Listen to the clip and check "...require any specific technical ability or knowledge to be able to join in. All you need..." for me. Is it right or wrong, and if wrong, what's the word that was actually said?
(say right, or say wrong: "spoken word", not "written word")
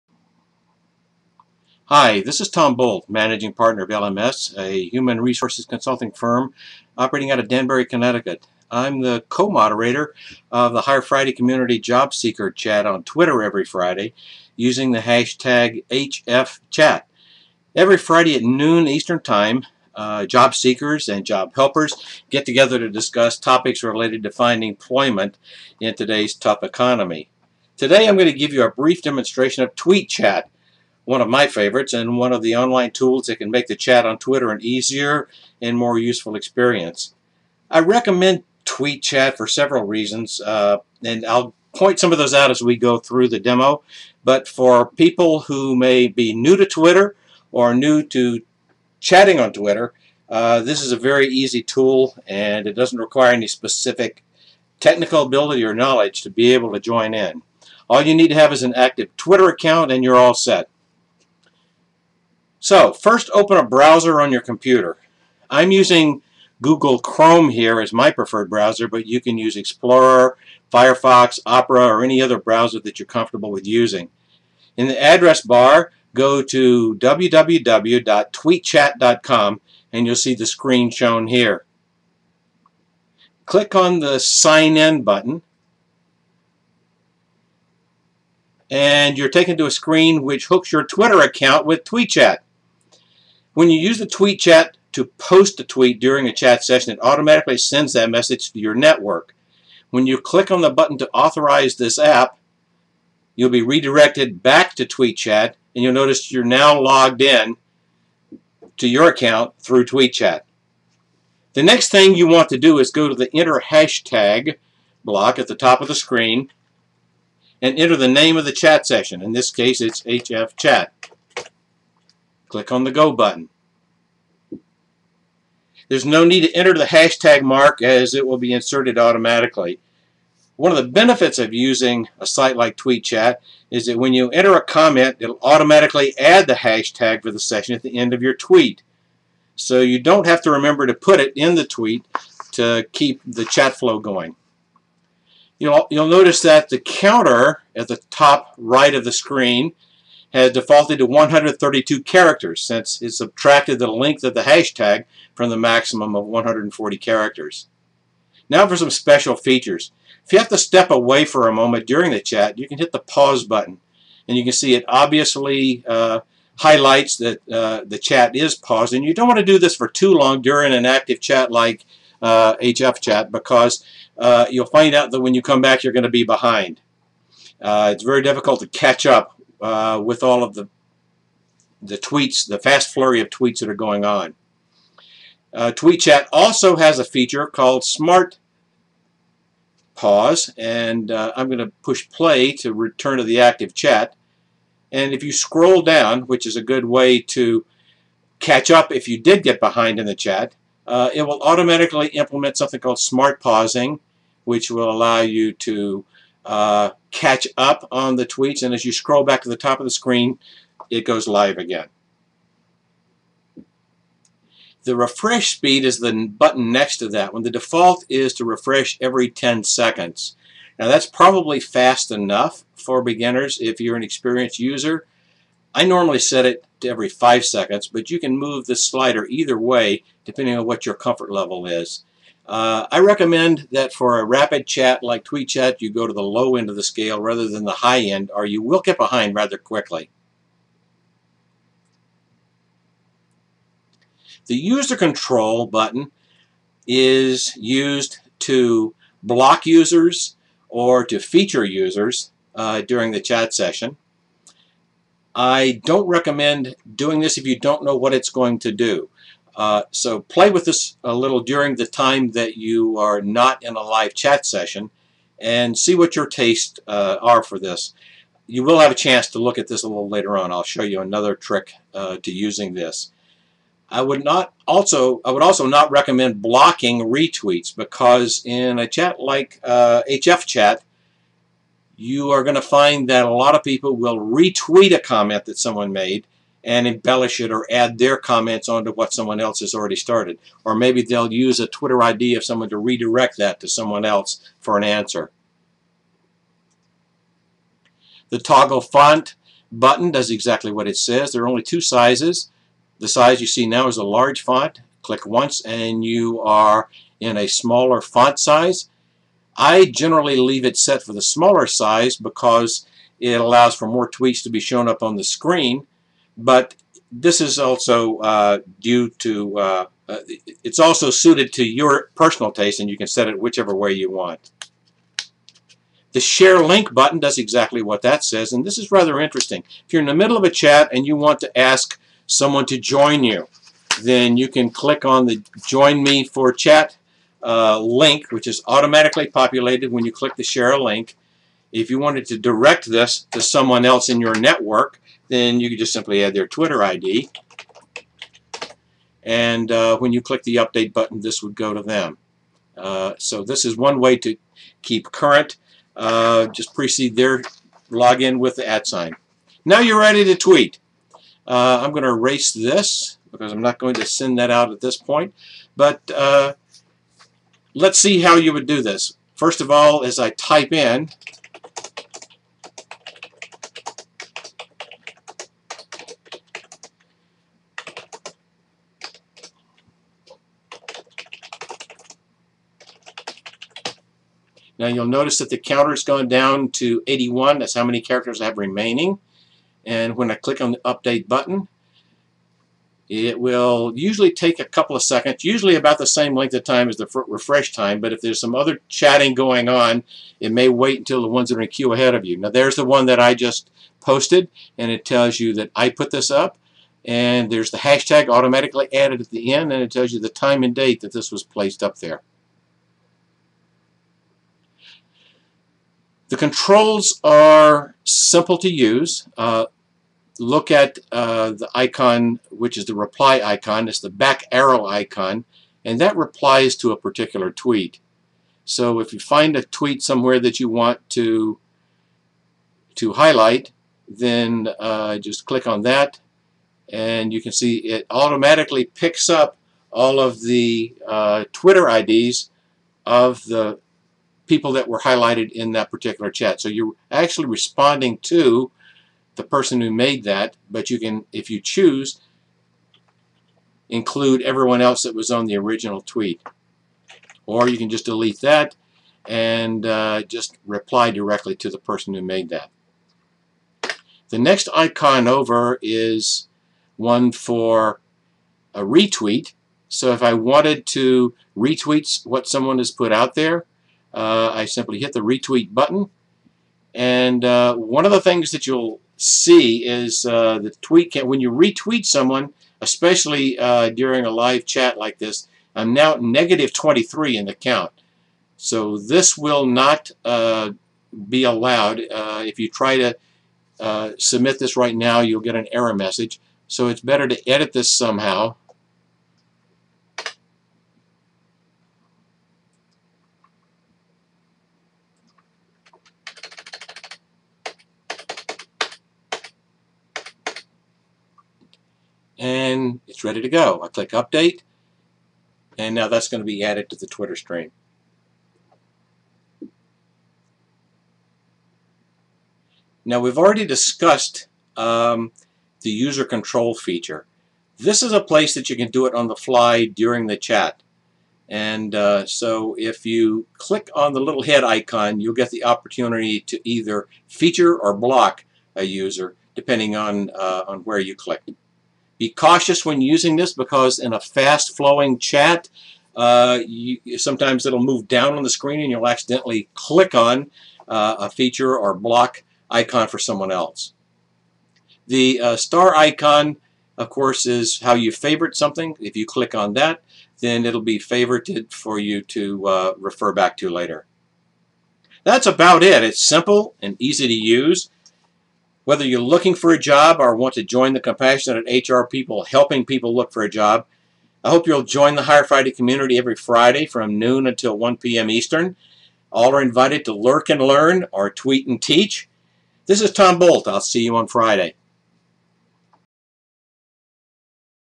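right.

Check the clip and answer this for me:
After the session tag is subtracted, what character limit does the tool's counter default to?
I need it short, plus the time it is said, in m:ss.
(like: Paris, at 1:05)
132, at 2:31.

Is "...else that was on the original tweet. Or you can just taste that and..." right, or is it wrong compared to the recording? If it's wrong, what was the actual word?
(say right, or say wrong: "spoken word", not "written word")
wrong: "delete", not "taste".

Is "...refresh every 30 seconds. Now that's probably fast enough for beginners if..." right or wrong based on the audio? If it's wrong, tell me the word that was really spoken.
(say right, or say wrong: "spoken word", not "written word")
wrong: "10", not "30".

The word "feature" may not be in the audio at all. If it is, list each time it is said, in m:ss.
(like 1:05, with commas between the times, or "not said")
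2:39, 3:07, 4:11, 8:46, 8:57, 9:11.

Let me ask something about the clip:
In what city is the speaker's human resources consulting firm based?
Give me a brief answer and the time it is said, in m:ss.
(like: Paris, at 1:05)
Danbury, Connecticut, at 0:07.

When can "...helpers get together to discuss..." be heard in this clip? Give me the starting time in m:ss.
0:21.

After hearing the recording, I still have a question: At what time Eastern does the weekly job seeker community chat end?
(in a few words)
1 p.m.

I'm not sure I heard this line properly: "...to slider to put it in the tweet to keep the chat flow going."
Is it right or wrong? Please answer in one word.
wrong.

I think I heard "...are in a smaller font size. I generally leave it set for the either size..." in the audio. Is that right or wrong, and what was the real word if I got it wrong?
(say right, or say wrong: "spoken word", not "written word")
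wrong: "smaller", not "either".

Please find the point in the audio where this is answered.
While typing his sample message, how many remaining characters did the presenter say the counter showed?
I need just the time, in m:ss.
6:27.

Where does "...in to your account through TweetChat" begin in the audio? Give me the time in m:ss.
1:47.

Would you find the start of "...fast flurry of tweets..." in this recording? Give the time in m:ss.
3:02.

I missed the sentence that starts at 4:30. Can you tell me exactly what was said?
I'll show you another trick uh, to using this.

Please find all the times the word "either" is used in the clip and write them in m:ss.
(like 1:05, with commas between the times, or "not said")
3:49, 8:56.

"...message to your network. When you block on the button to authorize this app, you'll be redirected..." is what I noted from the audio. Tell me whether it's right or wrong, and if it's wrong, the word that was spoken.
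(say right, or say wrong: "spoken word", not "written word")
wrong: "click", not "block".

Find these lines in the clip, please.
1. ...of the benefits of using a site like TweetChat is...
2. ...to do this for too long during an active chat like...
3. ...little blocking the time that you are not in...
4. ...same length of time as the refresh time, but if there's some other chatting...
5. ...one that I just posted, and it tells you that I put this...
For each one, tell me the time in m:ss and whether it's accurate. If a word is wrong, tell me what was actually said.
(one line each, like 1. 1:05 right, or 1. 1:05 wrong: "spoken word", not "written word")
1. 2:10 right
2. 2:49 right
3. 4:21 wrong: "during", not "blocking"
4. 6:36 right
5. 6:42 right.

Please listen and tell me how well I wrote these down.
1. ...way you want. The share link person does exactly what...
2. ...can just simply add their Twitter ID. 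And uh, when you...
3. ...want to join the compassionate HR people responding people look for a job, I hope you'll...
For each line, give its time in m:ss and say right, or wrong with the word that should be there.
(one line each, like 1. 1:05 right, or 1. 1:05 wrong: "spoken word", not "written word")
1. 5:23 wrong: "button", not "person"
2. 5:45 right
3. 9:30 wrong: "helping", not "responding".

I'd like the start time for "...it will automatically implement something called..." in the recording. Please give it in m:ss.
3:21.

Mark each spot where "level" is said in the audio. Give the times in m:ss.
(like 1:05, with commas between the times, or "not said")
3:51.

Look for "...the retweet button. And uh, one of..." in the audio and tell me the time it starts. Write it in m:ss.
7:55.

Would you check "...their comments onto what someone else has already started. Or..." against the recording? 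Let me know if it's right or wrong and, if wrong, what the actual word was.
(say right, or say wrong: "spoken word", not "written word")
right.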